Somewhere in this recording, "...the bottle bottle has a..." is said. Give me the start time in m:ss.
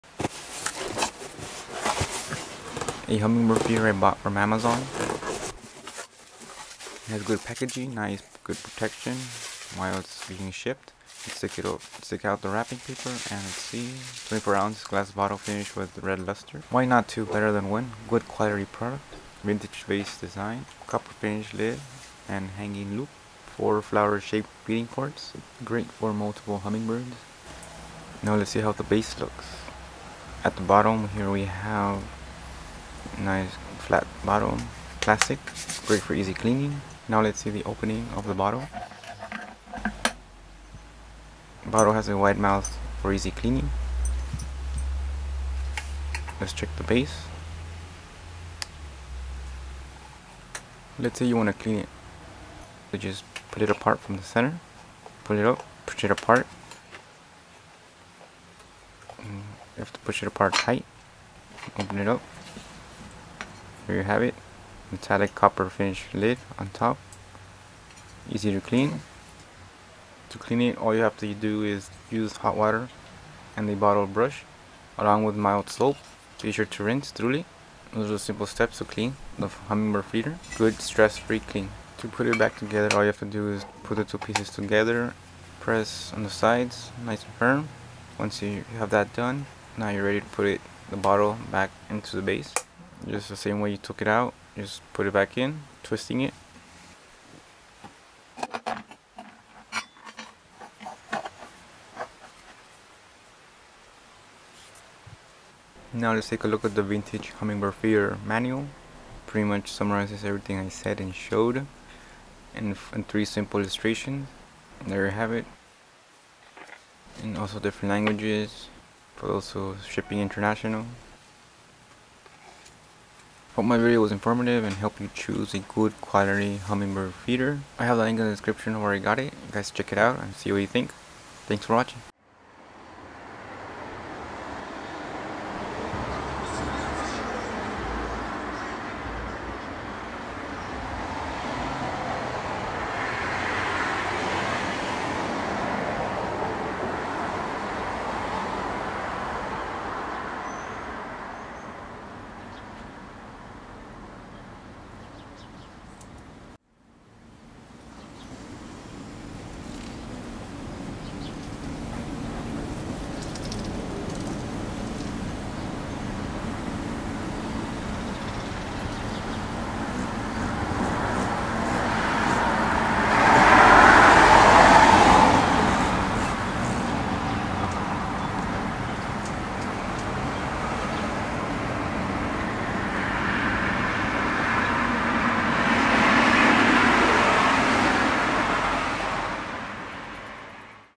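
0:38.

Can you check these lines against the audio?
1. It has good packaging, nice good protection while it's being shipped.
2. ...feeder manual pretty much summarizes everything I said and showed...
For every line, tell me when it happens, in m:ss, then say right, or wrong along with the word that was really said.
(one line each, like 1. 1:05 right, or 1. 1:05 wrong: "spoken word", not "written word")
1. 0:07 right
2. 1:47 right.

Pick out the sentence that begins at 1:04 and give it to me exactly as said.
Metallic copper finish lid on top.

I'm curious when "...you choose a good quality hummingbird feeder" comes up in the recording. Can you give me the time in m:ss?
2:05.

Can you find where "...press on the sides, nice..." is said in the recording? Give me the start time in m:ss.
1:25.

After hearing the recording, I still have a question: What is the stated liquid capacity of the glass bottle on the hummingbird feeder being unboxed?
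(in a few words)
24 ounces.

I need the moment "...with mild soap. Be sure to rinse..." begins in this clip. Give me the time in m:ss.
1:15.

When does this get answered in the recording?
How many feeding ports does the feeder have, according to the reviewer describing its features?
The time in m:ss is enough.
0:23.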